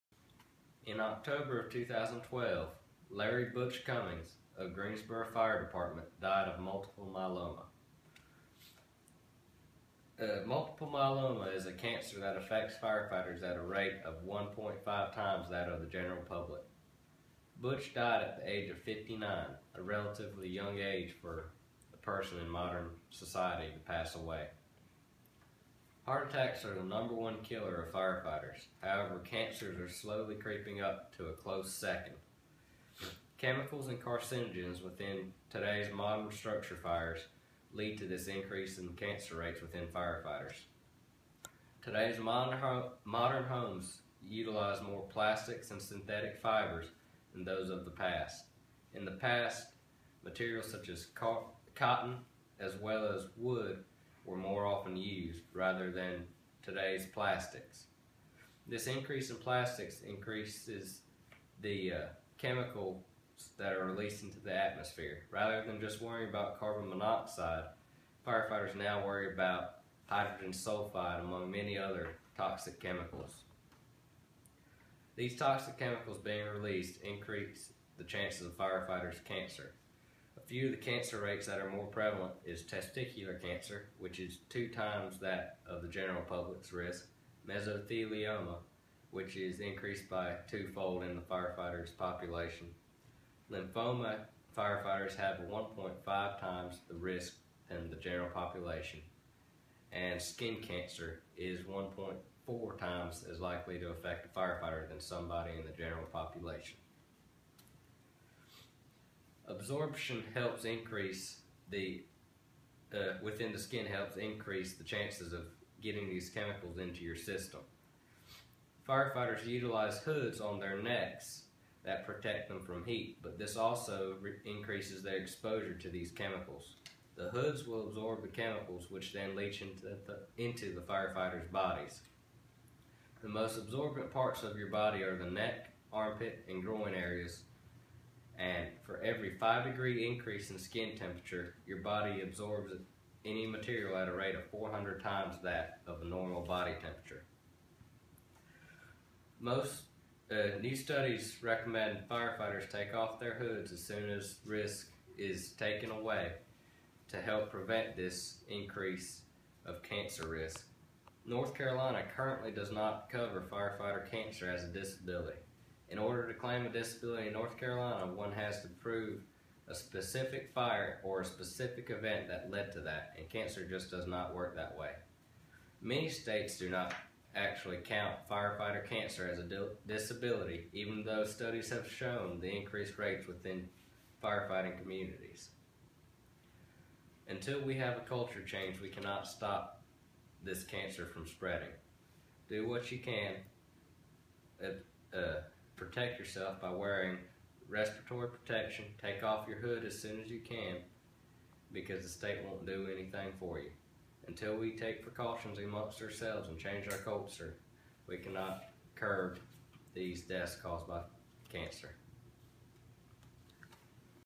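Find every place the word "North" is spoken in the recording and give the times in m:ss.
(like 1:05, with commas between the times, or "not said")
2:41, 2:47.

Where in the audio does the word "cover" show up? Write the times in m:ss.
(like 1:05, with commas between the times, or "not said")
2:43.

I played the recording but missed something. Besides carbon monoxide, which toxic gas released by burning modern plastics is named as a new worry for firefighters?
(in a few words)
hydrogen sulfide.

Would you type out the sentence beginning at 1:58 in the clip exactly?
Firefighters utilize hoods on their necks that protect them from heat, but this also increases their exposure to these chemicals.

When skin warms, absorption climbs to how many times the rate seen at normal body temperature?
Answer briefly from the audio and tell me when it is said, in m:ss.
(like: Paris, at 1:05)
400 times, at 2:24.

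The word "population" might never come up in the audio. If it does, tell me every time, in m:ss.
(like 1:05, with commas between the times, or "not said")
1:31, 1:38, 1:46.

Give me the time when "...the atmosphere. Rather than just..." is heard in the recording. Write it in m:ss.
1:04.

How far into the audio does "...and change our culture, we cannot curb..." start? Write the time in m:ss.
3:26.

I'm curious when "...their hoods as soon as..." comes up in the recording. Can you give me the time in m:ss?
2:33.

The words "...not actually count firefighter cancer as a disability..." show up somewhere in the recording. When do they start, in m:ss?
2:56.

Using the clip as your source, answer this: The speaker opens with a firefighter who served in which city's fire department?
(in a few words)
Greensboro.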